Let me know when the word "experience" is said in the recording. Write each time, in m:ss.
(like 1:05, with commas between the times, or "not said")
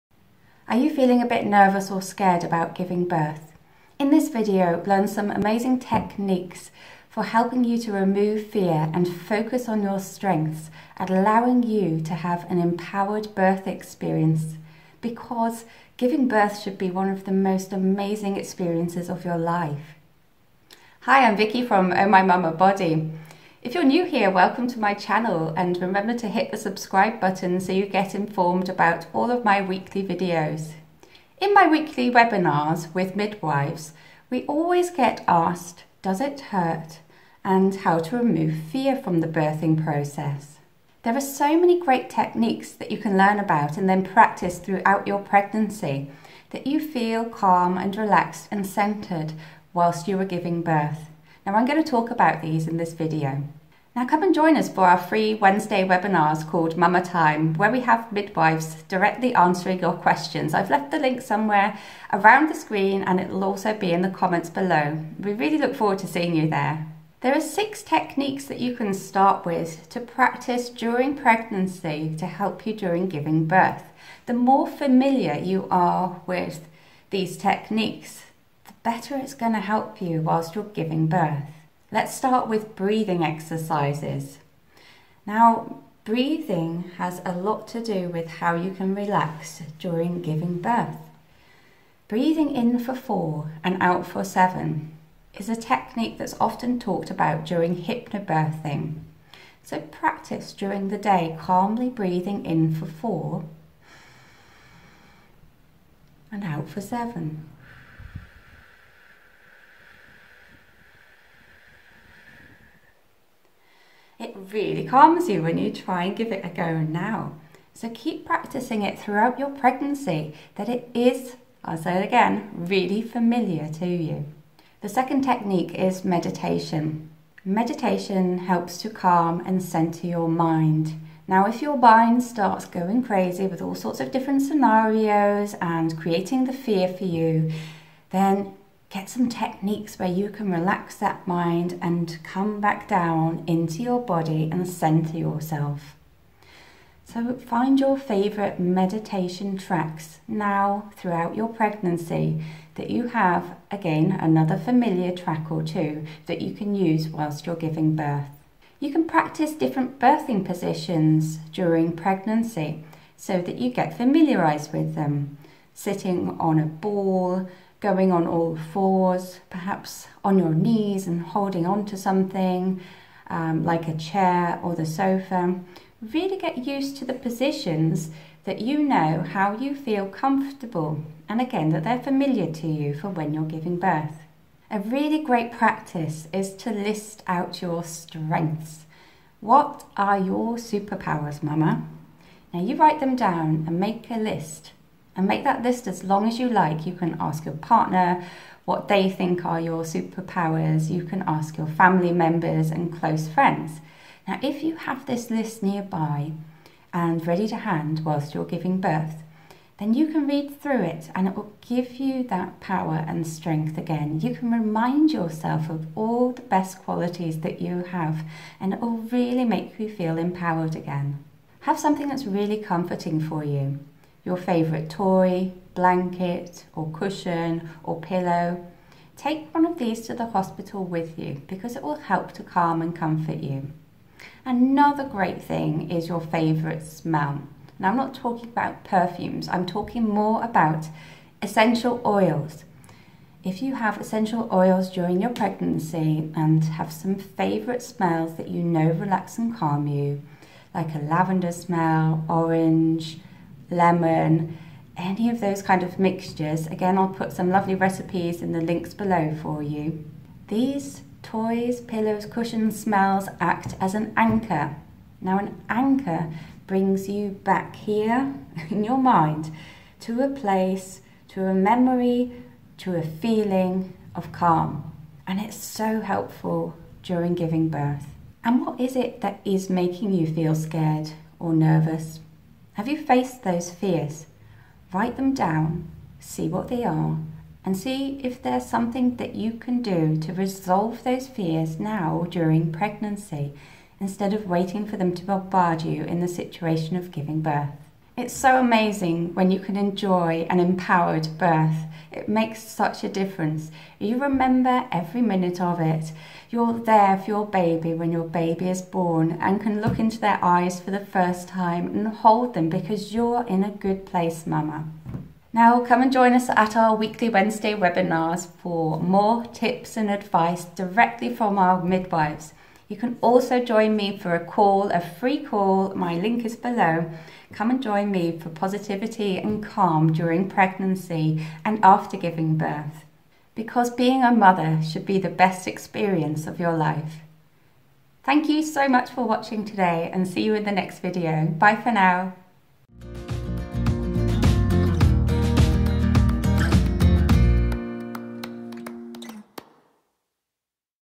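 0:13, 0:18, 5:35.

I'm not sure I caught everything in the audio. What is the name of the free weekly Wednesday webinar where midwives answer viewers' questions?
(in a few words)
Mama Time.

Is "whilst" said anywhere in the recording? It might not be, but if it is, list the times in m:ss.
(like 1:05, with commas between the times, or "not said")
0:49, 1:20, 2:37, 3:28.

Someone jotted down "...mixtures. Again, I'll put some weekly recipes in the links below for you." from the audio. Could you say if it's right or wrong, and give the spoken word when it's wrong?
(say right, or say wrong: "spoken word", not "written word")
wrong: "lovely", not "weekly".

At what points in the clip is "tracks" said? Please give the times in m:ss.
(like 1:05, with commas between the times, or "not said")
2:29, 2:35.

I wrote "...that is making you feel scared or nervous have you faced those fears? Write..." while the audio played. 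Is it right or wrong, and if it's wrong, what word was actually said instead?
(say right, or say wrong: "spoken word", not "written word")
right.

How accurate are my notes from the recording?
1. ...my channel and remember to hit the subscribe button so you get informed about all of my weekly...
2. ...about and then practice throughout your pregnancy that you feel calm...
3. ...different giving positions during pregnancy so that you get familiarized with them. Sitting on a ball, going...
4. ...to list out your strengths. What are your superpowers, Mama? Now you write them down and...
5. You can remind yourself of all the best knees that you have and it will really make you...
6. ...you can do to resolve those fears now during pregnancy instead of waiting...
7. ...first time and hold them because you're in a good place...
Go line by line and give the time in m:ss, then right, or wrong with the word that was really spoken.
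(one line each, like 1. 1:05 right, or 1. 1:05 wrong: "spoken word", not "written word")
1. 0:24 right
2. 0:43 right
3. 2:39 wrong: "birthing", not "giving"
4. 3:06 right
5. 3:34 wrong: "qualities", not "knees"
6. 4:49 right
7. 5:11 right.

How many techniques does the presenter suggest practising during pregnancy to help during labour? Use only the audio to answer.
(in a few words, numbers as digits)
6.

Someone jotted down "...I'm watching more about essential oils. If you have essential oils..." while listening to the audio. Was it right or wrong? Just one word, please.
wrong.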